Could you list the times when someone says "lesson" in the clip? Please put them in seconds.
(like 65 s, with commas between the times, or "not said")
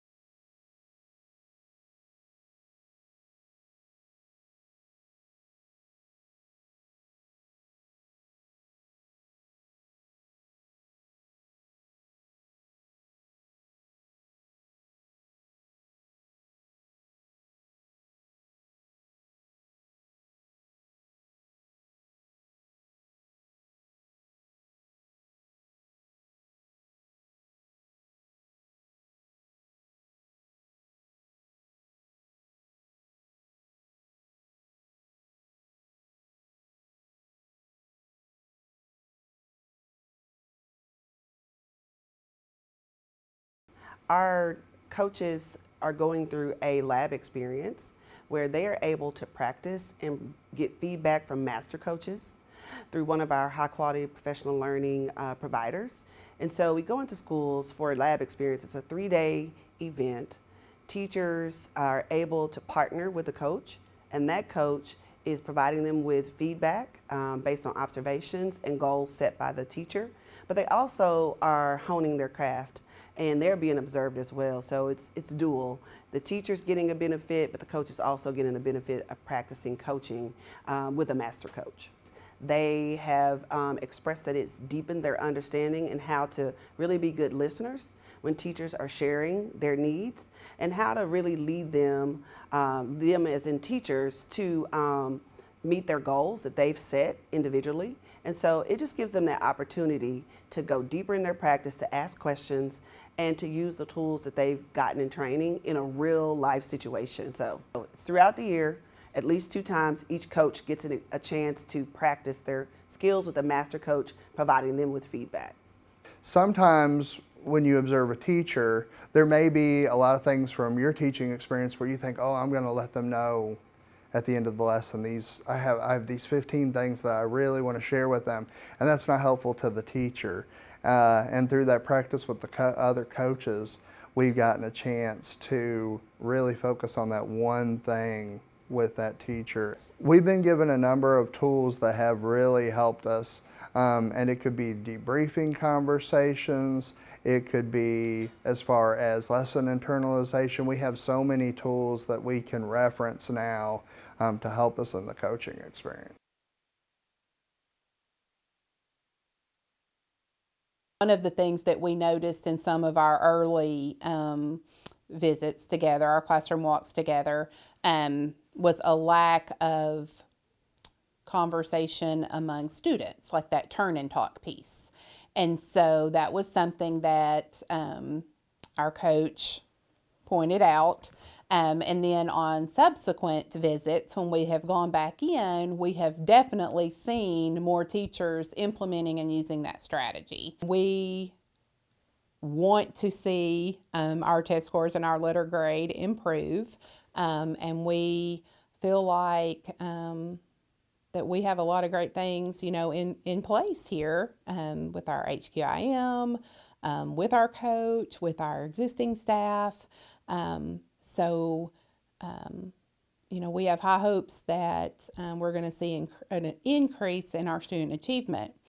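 124 s, 149 s.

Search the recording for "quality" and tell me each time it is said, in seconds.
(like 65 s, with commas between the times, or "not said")
53 s.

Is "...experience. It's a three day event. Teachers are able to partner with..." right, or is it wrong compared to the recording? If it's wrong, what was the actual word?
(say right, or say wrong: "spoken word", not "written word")
right.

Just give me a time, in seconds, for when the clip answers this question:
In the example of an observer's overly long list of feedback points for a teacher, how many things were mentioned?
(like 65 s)
126 s.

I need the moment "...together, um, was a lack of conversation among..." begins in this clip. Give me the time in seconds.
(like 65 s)
166 s.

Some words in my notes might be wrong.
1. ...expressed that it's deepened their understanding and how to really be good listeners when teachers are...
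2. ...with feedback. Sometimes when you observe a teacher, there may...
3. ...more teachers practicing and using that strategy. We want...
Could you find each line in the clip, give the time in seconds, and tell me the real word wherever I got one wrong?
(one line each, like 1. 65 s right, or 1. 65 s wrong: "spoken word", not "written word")
1. 83 s right
2. 114 s right
3. 187 s wrong: "implementing", not "practicing".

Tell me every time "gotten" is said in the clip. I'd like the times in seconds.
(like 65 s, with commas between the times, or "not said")
104 s, 134 s.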